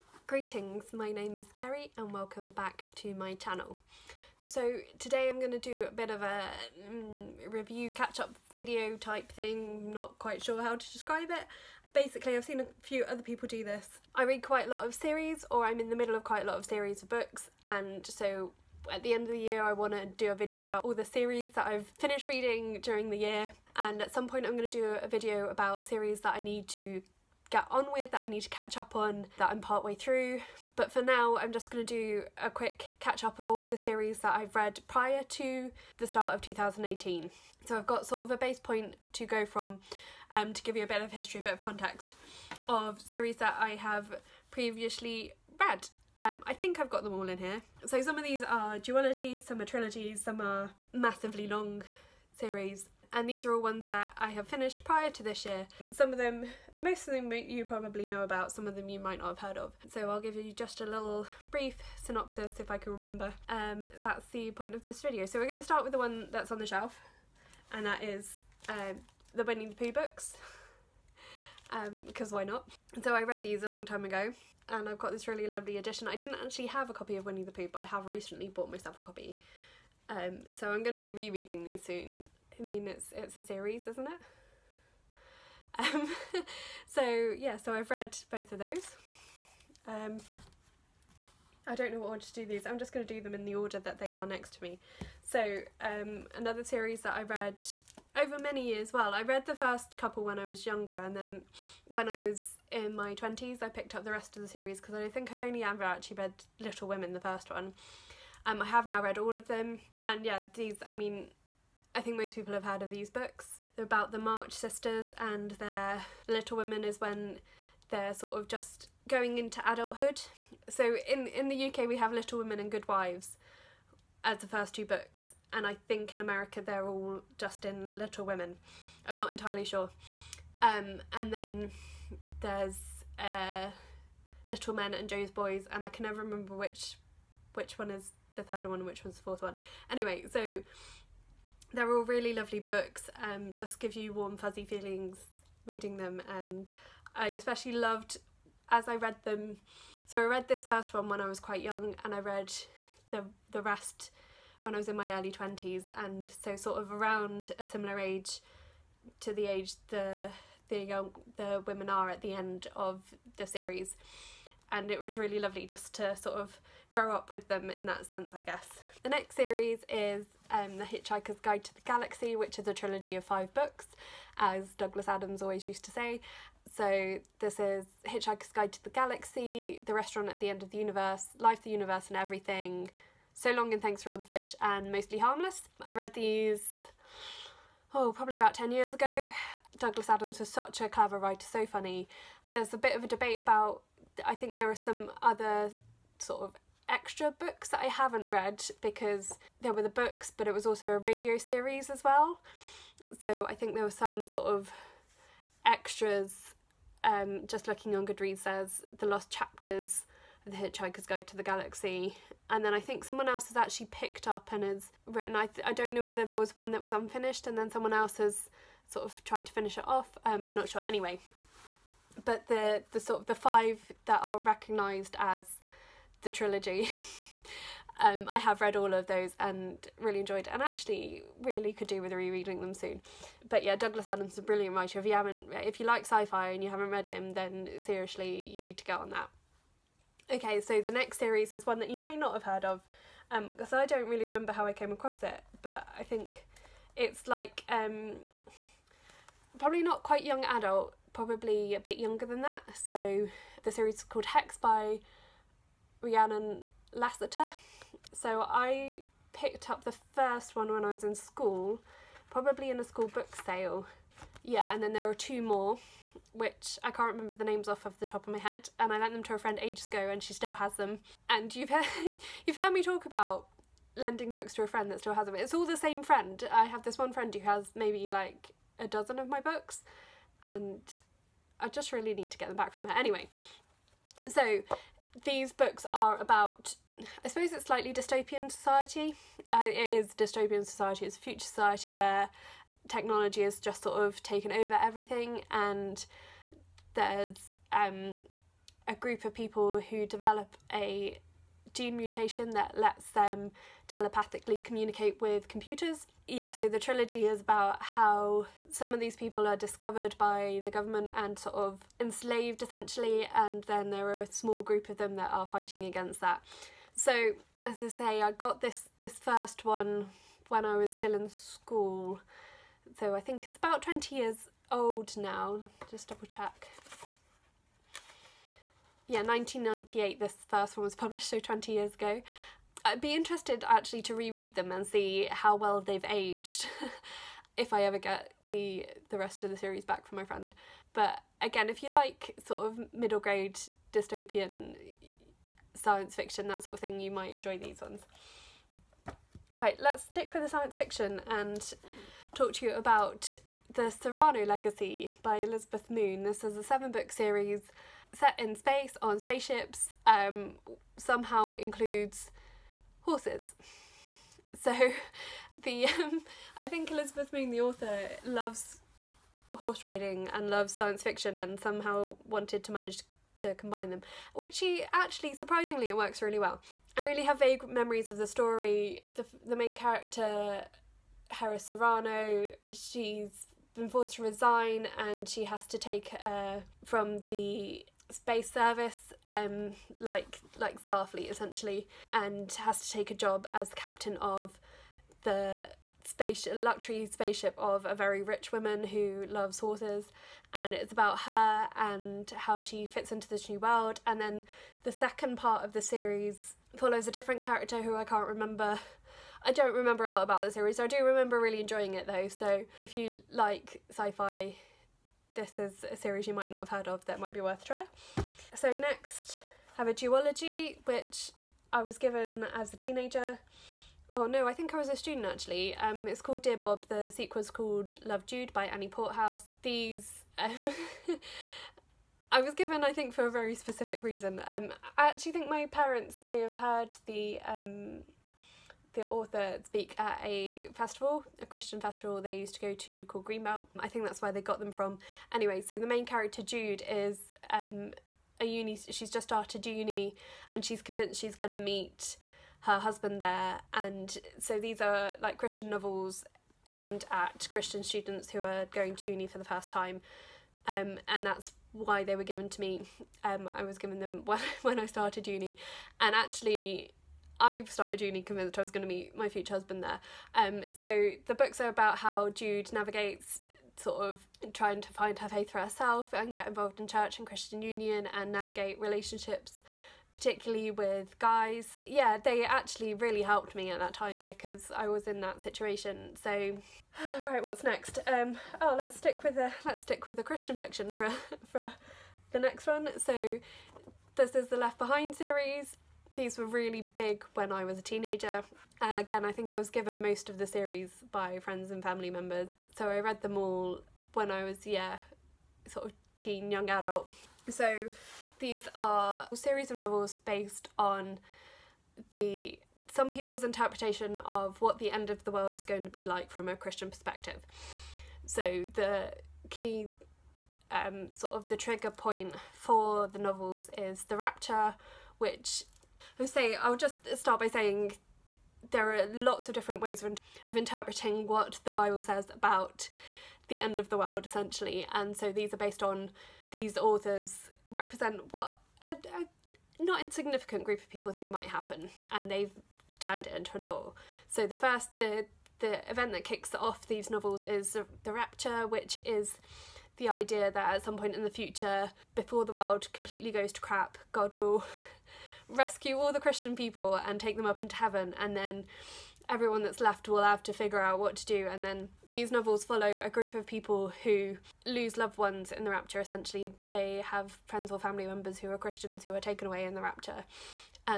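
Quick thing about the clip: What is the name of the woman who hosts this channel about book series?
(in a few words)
Ceri.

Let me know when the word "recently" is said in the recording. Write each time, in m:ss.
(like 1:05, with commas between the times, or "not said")
1:18.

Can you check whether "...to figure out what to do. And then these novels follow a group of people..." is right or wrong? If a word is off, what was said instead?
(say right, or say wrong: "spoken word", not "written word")
right.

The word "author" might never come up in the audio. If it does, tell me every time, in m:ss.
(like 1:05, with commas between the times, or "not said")
6:07, 7:19, 8:56.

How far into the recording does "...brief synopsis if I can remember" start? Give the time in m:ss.
1:01.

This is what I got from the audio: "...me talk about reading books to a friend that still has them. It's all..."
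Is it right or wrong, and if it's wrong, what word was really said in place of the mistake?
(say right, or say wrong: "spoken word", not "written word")
wrong: "lending", not "reading".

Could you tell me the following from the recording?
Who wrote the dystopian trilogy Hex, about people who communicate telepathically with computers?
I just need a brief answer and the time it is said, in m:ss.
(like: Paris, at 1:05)
Rhiannon Lassiter, at 4:16.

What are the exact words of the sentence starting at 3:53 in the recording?
But yeah, Douglas Adams is a brilliant writer.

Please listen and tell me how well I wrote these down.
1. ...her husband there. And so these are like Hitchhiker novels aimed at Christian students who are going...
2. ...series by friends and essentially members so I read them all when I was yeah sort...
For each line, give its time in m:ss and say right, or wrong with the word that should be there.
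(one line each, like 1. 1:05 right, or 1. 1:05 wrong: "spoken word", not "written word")
1. 7:32 wrong: "Christian", not "Hitchhiker"
2. 8:20 wrong: "family", not "essentially".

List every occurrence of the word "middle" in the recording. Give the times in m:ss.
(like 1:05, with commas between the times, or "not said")
0:15, 5:42.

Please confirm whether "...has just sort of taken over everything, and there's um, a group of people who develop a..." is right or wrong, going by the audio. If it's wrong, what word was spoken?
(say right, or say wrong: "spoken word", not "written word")
right.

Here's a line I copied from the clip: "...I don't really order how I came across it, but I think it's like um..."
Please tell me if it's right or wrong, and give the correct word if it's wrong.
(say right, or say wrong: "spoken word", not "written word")
wrong: "remember", not "order".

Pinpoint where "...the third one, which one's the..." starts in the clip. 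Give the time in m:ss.
2:18.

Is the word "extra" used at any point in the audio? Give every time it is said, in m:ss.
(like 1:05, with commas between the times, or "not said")
3:16, 3:25.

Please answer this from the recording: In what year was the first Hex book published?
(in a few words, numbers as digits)
1998.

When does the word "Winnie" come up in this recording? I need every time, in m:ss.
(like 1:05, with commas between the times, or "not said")
1:09, 1:17.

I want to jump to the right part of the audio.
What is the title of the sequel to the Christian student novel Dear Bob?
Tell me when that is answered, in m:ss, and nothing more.
7:08.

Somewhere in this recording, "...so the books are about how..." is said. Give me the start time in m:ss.
7:50.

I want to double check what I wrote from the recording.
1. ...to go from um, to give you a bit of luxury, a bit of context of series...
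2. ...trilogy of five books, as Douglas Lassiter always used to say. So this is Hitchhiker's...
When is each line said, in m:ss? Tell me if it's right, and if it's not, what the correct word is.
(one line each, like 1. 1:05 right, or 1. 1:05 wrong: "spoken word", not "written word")
1. 0:39 wrong: "history", not "luxury"
2. 2:52 wrong: "Adams", not "Lassiter".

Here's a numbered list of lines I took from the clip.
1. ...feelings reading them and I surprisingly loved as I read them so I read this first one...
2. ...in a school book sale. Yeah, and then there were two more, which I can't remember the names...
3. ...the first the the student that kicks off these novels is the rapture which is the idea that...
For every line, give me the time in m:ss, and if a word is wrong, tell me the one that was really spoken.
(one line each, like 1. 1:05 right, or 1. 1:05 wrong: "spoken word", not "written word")
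1. 2:24 wrong: "especially", not "surprisingly"
2. 4:22 right
3. 9:04 wrong: "event", not "student".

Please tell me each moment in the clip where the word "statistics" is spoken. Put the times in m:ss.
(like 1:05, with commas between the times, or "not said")
not said.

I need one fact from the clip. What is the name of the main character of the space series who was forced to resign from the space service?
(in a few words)
Heris Serrano.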